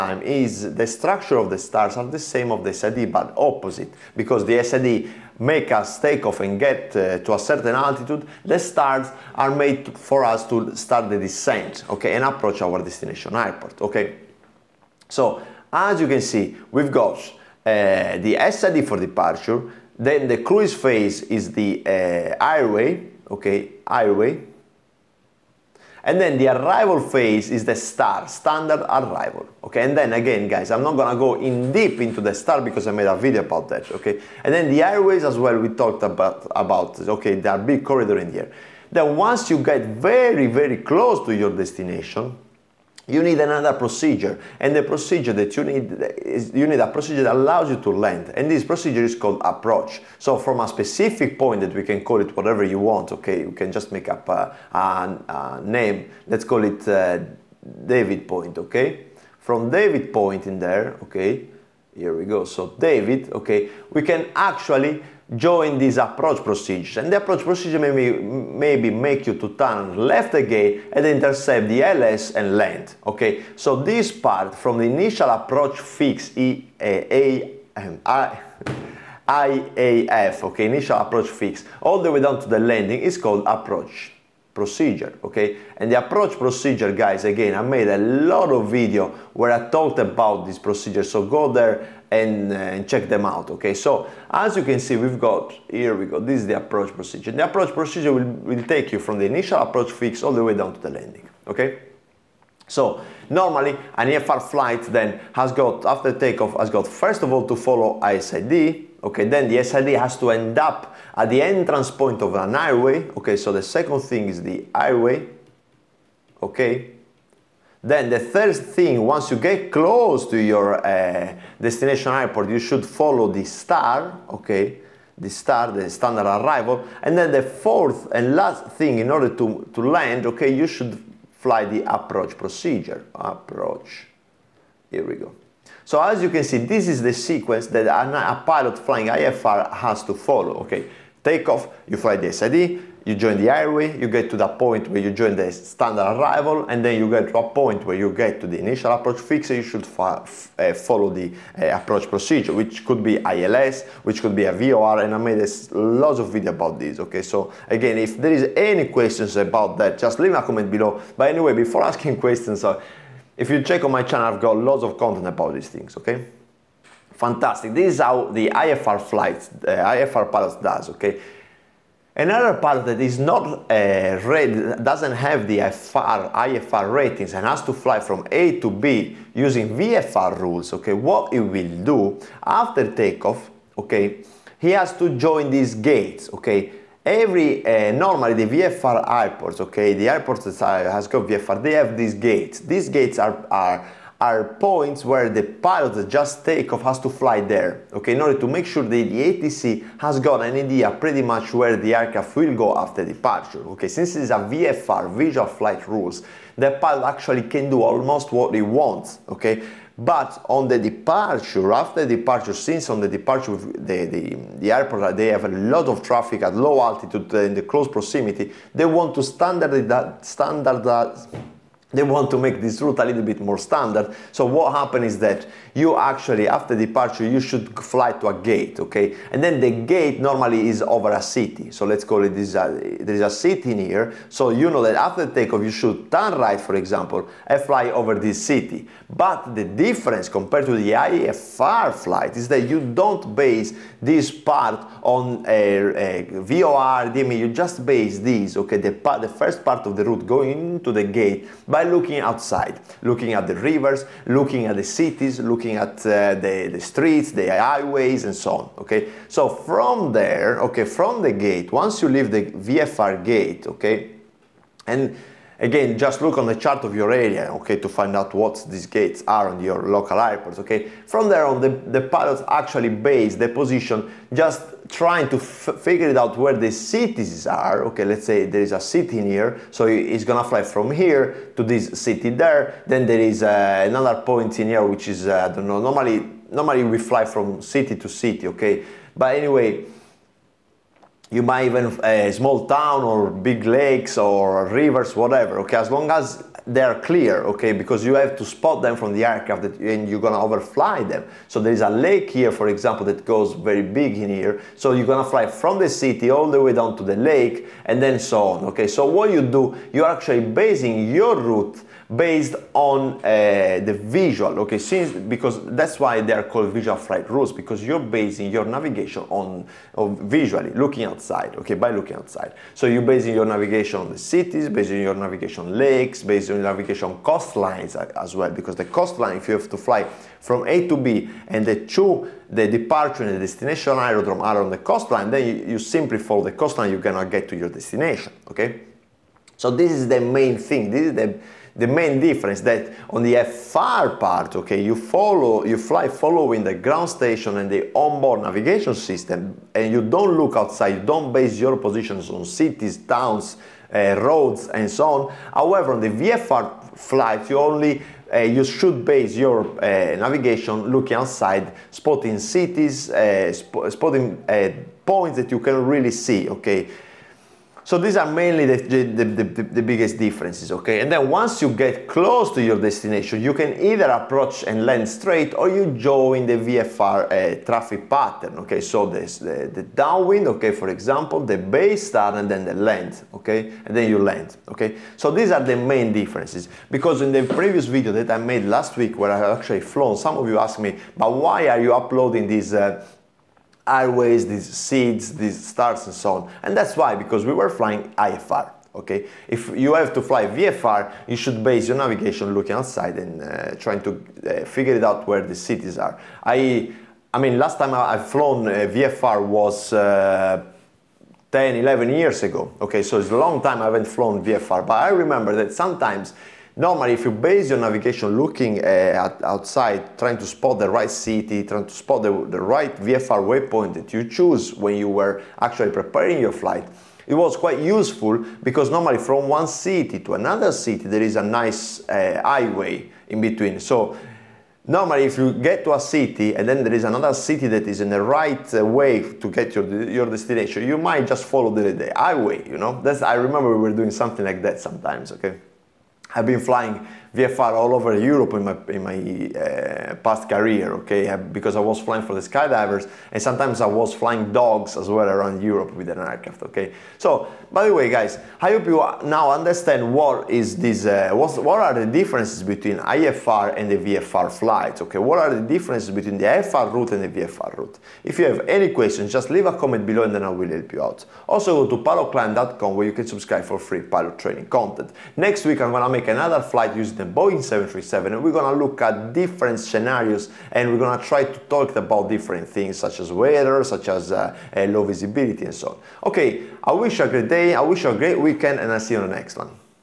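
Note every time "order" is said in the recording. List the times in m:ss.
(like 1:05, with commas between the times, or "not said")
2:09, 3:18.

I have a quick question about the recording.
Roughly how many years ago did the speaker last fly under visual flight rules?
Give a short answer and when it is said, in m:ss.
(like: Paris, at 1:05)
10 to 11 years, at 6:51.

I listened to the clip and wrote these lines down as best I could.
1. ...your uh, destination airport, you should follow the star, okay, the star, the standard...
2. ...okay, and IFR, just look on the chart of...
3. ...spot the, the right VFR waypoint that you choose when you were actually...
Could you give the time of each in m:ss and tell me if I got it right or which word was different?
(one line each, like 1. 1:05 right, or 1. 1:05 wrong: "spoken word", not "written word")
1. 2:00 right
2. 4:23 wrong: "Again", not "IFR"
3. 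7:01 right.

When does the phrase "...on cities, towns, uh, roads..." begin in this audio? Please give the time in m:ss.
5:52.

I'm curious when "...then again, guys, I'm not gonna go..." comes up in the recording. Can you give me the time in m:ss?
0:29.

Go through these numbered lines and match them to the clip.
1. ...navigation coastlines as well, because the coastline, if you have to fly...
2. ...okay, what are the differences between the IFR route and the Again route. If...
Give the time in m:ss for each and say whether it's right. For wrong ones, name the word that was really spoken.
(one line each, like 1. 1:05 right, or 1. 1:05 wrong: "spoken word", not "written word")
1. 5:26 right
2. 7:45 wrong: "VFR", not "Again".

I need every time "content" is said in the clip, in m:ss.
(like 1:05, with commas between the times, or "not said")
2:44, 7:54.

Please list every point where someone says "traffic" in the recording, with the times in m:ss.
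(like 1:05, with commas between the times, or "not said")
3:36, 6:17.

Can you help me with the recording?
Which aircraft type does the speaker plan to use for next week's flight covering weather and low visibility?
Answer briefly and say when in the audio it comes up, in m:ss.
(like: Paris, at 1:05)
Boeing 737, at 7:57.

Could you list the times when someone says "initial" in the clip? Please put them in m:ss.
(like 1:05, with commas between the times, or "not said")
1:14, 1:20, 1:39, 2:28.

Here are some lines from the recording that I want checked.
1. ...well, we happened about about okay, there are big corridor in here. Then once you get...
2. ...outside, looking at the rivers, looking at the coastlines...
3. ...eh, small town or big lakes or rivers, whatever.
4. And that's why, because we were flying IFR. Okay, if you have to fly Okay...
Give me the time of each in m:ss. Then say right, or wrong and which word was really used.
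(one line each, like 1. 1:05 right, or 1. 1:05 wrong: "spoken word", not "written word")
1. 0:35 wrong: "talked", not "happened"
2. 4:12 wrong: "cities", not "coastlines"
3. 4:52 right
4. 6:36 wrong: "VFR", not "Okay".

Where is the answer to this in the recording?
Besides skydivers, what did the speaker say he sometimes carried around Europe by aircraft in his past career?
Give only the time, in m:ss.
7:34.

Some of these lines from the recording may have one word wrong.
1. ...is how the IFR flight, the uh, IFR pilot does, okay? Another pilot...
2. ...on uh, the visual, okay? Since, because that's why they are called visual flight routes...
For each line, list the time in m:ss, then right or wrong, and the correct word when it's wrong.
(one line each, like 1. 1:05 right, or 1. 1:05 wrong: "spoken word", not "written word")
1. 2:47 right
2. 5:12 right.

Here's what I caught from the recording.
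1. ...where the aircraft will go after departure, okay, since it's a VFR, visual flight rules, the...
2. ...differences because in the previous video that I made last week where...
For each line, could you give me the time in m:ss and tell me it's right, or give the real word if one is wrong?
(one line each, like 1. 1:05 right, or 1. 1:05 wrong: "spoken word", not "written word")
1. 3:21 right
2. 6:26 right.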